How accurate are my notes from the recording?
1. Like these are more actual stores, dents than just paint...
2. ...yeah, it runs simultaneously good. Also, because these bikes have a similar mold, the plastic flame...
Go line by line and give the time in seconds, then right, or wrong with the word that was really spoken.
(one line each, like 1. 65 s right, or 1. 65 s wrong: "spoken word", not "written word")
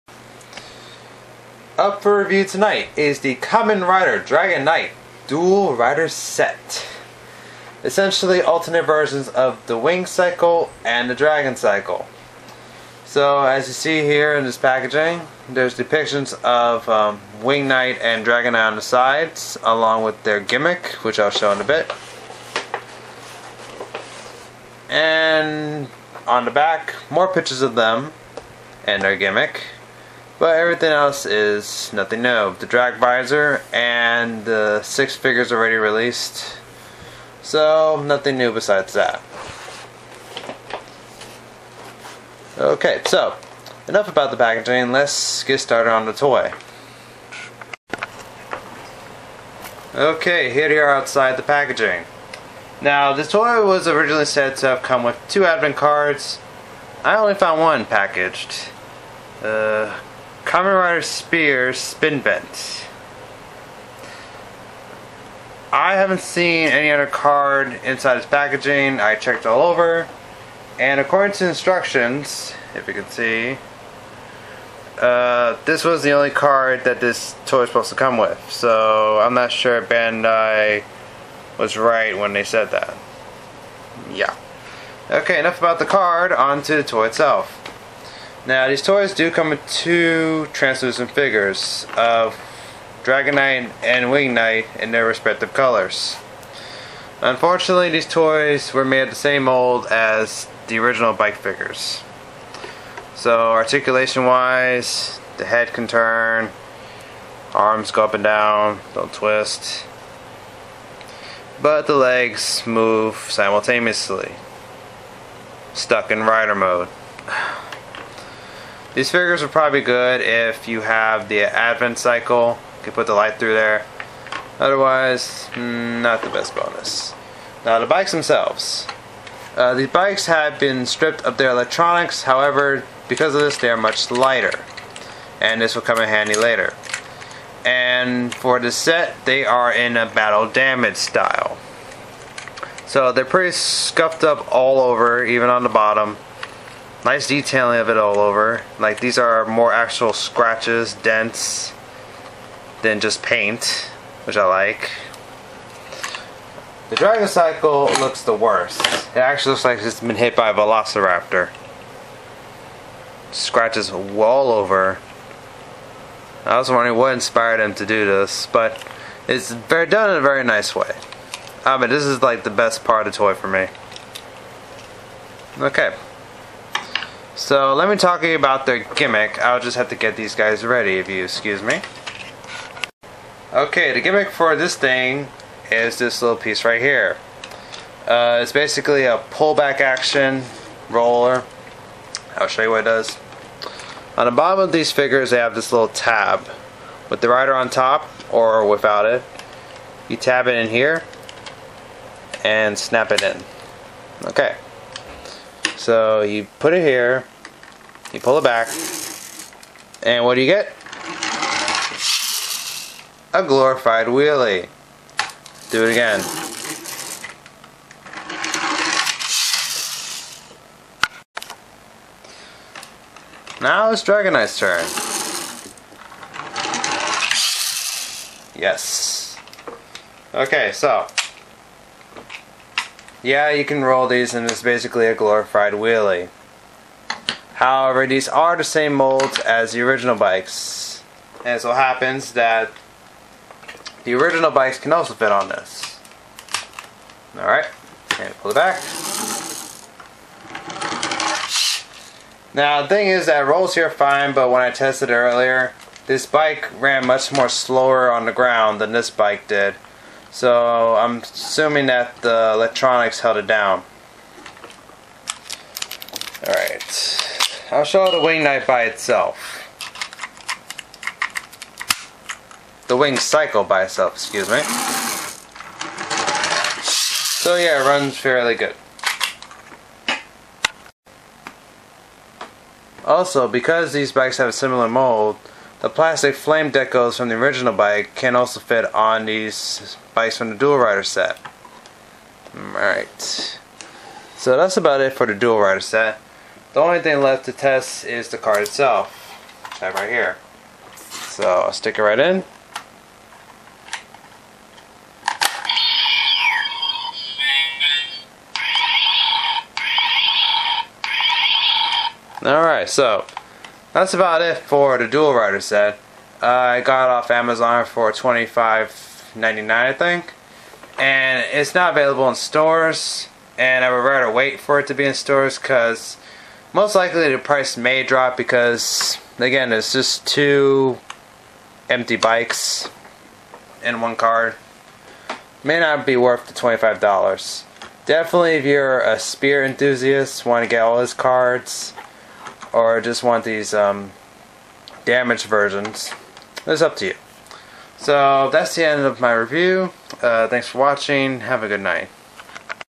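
1. 148 s wrong: "scratches", not "stores"
2. 277 s wrong: "fairly", not "simultaneously".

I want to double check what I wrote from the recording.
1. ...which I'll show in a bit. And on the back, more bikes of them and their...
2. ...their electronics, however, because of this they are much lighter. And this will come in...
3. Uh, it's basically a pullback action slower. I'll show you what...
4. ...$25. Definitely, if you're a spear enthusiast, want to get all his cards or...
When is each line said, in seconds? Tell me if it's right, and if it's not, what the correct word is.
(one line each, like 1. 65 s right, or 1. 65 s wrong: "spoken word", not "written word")
1. 21 s wrong: "pictures", not "bikes"
2. 131 s right
3. 188 s wrong: "roller", not "slower"
4. 336 s right.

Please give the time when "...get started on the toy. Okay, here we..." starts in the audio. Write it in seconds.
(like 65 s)
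45 s.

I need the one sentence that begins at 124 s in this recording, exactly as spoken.
Otherwise, hmm, not the best bonus.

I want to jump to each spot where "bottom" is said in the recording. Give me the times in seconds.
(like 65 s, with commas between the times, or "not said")
145 s, 194 s.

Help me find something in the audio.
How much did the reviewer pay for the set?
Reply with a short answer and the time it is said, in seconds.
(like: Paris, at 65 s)
$25.99, at 318 s.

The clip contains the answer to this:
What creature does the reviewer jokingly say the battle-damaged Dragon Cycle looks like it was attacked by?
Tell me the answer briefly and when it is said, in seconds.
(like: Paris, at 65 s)
Velociraptor, at 160 s.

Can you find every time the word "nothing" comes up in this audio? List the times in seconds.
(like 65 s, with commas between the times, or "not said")
31 s, 38 s.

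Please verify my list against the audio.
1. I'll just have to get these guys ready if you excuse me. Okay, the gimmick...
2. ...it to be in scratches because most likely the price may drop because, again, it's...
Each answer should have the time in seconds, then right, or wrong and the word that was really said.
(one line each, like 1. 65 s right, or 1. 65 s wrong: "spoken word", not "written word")
1. 179 s right
2. 324 s wrong: "stores", not "scratches".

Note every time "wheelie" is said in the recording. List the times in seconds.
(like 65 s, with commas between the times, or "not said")
214 s, 235 s.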